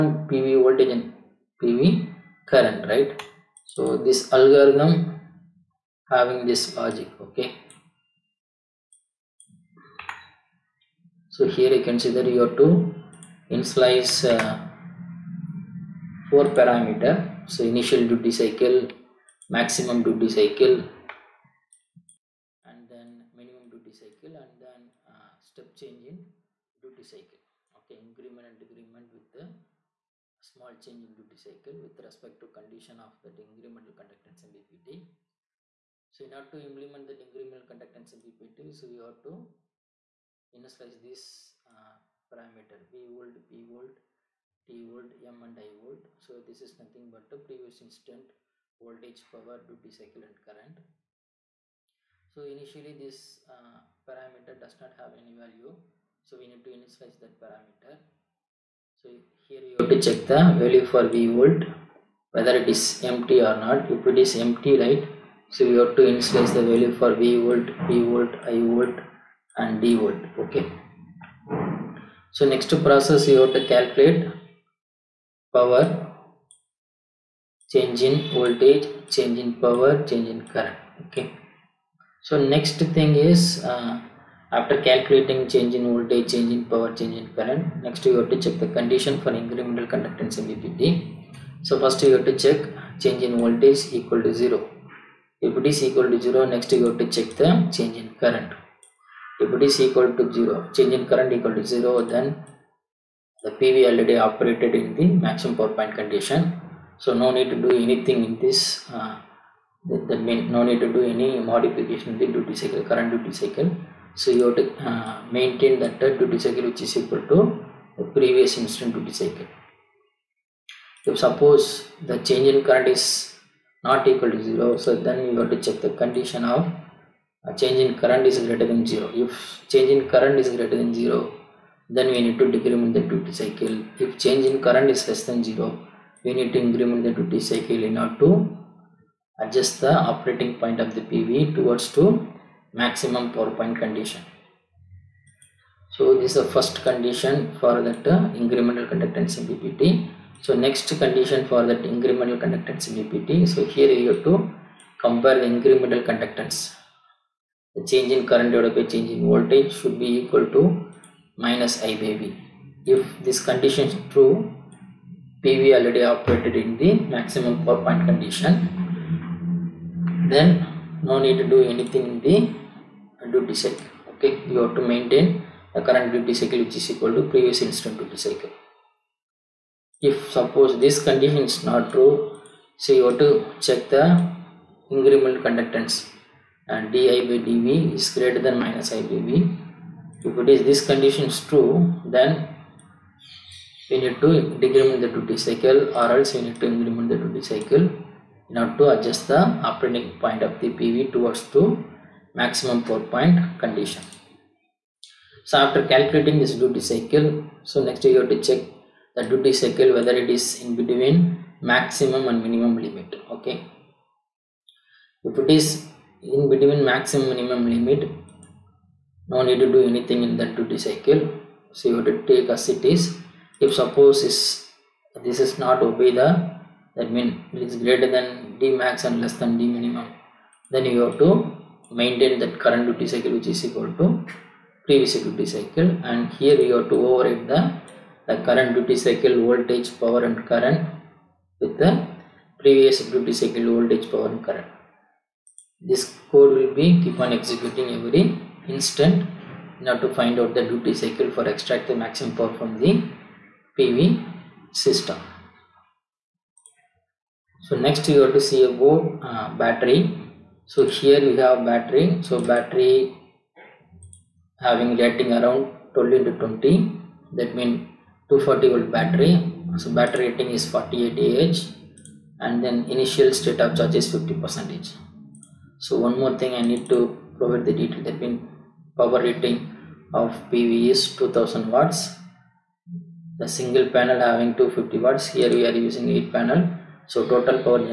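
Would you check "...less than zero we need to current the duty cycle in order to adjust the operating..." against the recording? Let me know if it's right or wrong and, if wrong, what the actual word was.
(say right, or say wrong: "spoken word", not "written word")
wrong: "increment", not "current".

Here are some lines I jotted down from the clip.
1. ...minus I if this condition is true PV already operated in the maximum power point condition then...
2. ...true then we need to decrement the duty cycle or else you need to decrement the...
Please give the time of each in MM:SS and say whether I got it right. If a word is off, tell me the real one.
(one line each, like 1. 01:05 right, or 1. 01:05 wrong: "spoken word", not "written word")
1. 02:41 right
2. 03:11 wrong: "increment", not "decrement".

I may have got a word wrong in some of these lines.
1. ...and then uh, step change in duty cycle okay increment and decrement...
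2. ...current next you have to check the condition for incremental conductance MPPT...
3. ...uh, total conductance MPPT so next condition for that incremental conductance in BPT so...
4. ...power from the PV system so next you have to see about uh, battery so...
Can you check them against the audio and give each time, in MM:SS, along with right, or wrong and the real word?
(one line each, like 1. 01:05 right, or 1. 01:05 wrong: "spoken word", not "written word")
1. 00:24 right
2. 01:27 right
3. 02:28 wrong: "incremental", not "total"
4. 04:12 right.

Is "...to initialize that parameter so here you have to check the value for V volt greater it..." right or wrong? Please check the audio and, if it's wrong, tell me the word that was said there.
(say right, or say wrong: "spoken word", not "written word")
wrong: "whether", not "greater".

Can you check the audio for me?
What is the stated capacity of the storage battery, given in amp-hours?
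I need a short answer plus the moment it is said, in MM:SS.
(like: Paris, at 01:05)
48 Ah, at 04:30.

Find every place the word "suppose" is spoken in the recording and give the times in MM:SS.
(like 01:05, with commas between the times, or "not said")
02:01, 03:00, 03:43.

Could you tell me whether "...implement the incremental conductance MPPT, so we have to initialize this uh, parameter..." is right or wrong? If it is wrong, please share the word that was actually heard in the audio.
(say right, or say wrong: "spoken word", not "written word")
right.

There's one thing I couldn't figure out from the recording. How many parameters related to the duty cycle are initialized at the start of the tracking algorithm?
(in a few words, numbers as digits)
4.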